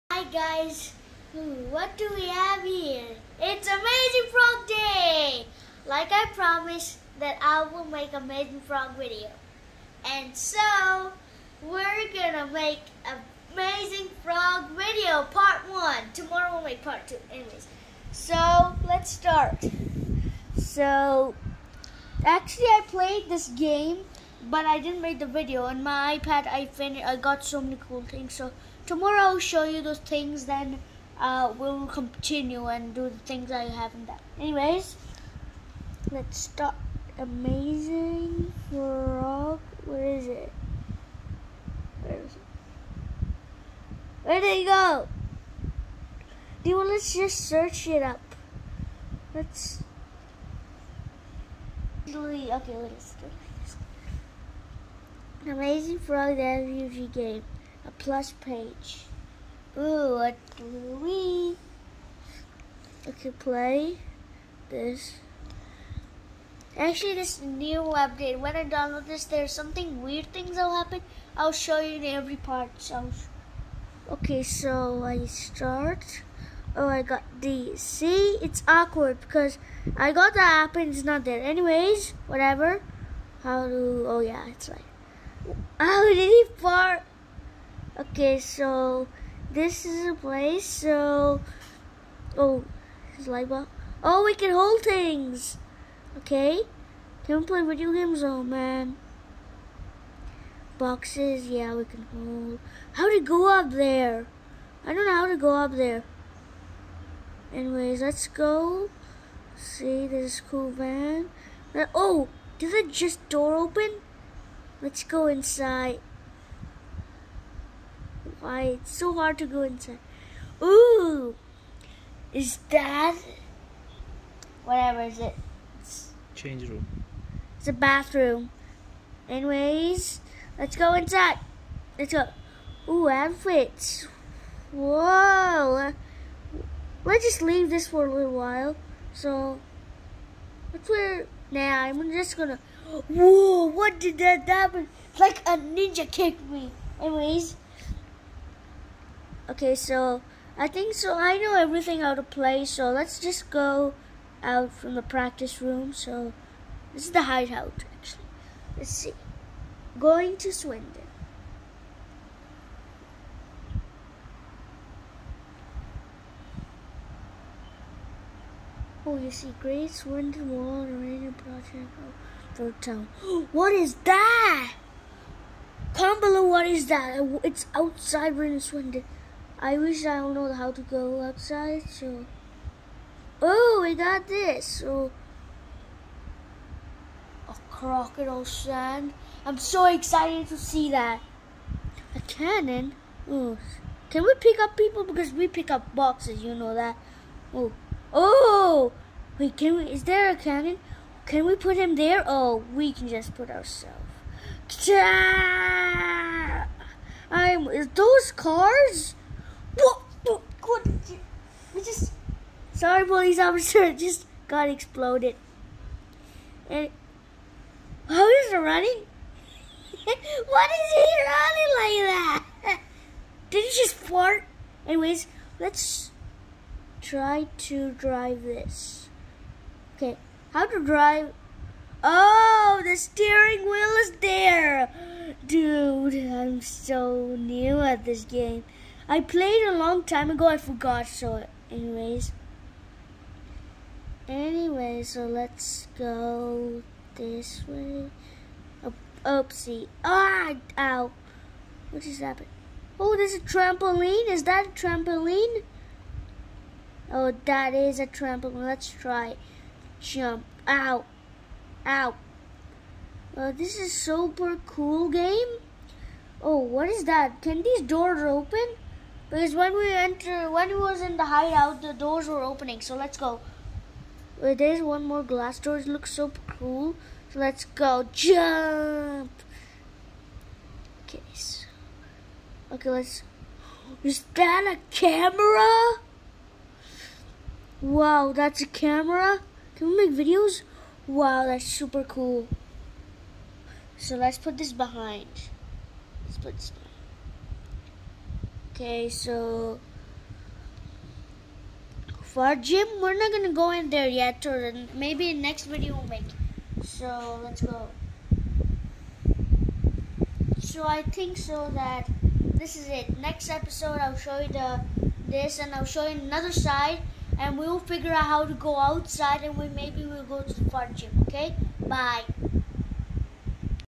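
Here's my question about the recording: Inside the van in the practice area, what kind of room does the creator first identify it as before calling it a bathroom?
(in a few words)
Change room.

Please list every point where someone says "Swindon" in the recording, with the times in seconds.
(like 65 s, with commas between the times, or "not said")
160 s, 169 s, 178 s.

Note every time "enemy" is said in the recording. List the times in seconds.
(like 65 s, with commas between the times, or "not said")
not said.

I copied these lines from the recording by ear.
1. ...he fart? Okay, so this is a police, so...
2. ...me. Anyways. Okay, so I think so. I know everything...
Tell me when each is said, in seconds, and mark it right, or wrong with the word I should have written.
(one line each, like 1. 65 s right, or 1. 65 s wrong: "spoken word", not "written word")
1. 86 s wrong: "place", not "police"
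2. 146 s right.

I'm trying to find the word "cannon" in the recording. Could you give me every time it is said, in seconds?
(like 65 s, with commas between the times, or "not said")
192 s, 200 s.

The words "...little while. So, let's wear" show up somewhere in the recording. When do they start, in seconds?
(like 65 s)
138 s.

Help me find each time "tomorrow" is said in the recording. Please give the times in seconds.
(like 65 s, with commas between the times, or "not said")
16 s, 28 s.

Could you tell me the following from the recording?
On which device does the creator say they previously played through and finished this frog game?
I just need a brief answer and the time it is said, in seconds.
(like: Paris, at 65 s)
iPad, at 26 s.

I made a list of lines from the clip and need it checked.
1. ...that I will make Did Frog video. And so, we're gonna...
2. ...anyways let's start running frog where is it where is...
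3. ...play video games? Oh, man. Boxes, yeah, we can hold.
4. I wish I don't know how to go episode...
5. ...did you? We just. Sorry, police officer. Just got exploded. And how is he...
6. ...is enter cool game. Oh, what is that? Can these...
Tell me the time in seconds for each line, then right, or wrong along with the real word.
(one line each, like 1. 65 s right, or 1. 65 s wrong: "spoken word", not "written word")
1. 7 s wrong: "Amazing", not "Did"
2. 34 s wrong: "amazing", not "running"
3. 97 s right
4. 179 s wrong: "outside", not "episode"
5. 210 s right
6. 263 s wrong: "super", not "enter".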